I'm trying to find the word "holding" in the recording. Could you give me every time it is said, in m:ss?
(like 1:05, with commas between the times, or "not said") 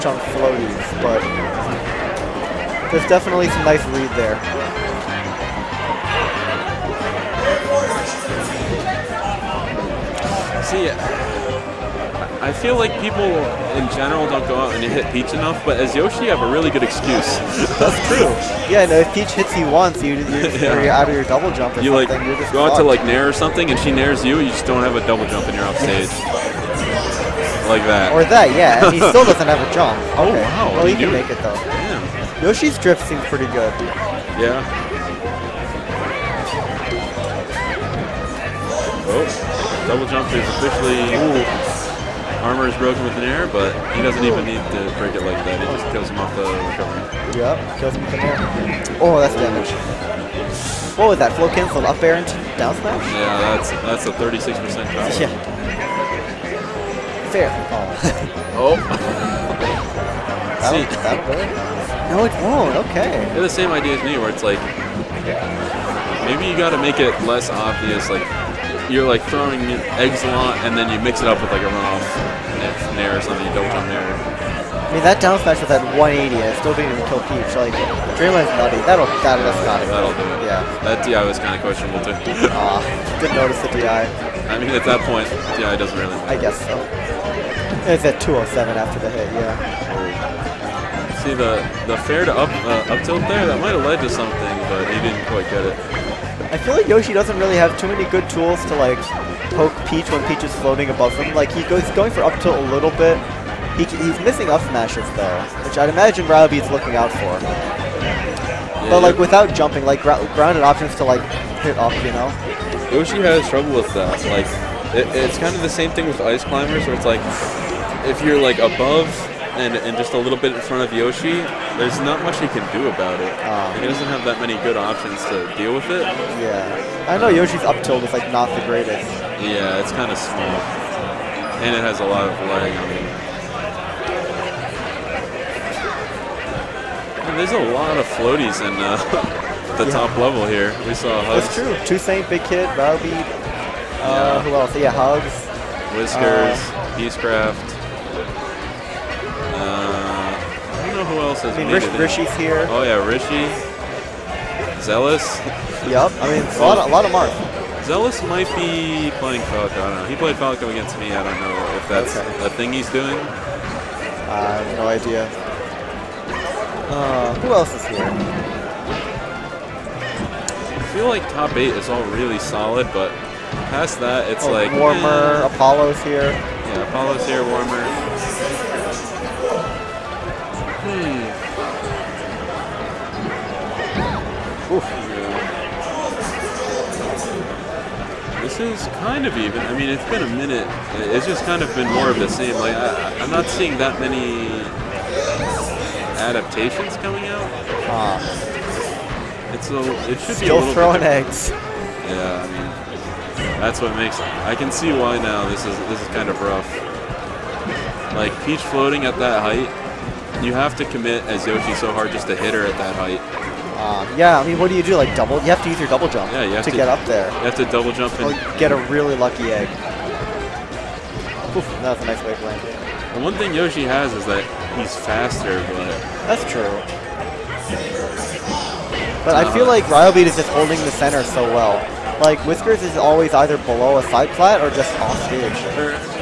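3:50.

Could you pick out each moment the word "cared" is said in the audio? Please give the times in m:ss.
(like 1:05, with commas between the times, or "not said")
not said.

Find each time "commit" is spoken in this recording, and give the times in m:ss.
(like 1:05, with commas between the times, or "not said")
3:30.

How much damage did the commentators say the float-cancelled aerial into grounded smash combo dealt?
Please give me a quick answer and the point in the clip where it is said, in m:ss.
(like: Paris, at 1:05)
36 percent, at 0:54.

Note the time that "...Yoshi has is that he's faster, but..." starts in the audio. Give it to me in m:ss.
3:43.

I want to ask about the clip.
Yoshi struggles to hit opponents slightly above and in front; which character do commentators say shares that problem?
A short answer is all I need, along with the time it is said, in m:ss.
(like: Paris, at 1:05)
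Ice Climbers, at 1:56.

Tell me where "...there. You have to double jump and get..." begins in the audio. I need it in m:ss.
3:37.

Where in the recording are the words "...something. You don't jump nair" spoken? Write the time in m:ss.
1:13.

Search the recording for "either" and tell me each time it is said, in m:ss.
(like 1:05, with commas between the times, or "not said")
3:53.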